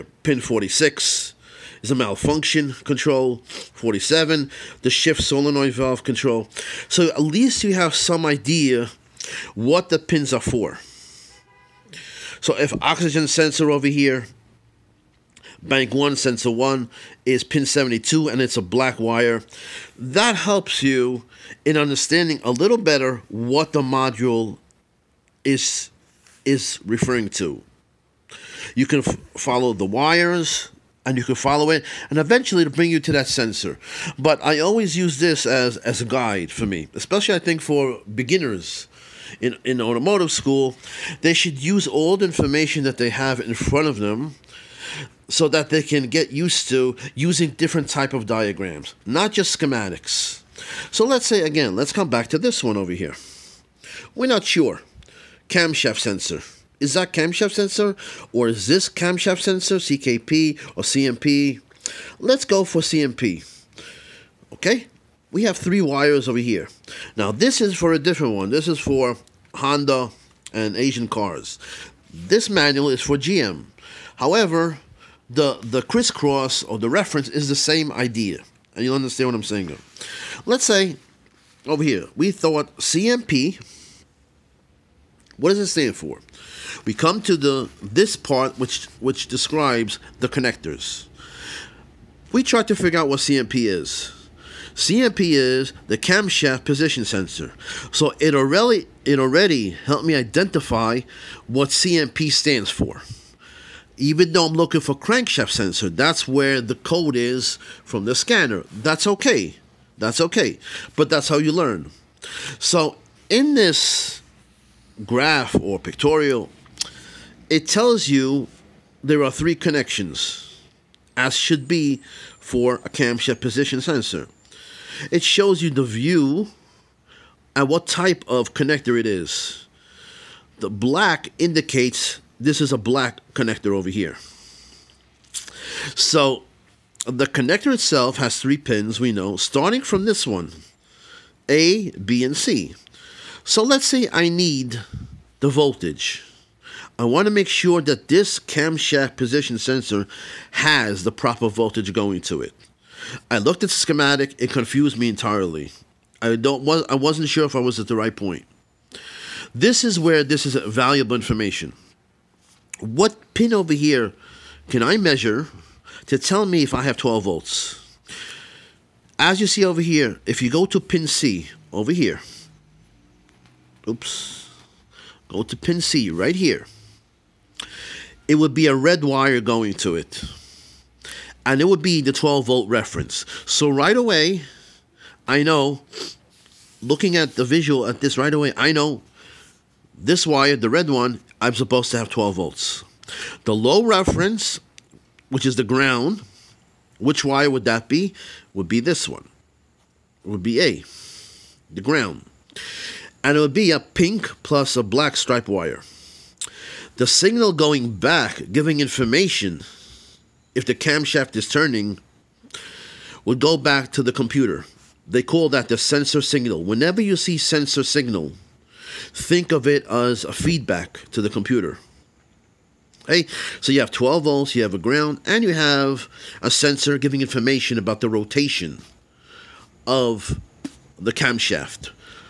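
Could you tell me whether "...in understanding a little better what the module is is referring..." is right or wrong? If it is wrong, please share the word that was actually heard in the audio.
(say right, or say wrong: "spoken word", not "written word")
right.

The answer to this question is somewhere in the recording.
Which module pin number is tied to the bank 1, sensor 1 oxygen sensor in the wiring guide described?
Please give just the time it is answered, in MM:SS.
00:17.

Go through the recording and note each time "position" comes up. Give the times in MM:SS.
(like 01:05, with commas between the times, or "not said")
01:36, 02:03, 02:29.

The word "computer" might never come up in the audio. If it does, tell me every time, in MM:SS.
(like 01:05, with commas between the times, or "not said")
03:34, 03:41.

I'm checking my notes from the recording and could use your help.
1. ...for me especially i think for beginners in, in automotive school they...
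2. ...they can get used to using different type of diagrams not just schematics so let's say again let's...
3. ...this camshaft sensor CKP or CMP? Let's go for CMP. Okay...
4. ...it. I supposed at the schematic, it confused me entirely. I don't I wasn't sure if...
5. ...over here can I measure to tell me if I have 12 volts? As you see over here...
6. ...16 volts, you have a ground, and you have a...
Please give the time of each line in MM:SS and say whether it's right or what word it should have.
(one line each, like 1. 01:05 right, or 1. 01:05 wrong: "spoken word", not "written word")
1. 00:36 right
2. 00:45 right
3. 00:58 right
4. 02:32 wrong: "looked", not "supposed"
5. 02:43 right
6. 03:43 wrong: "12", not "16".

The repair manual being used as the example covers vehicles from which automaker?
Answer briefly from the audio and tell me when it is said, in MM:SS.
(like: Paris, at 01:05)
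GM, at 01:13.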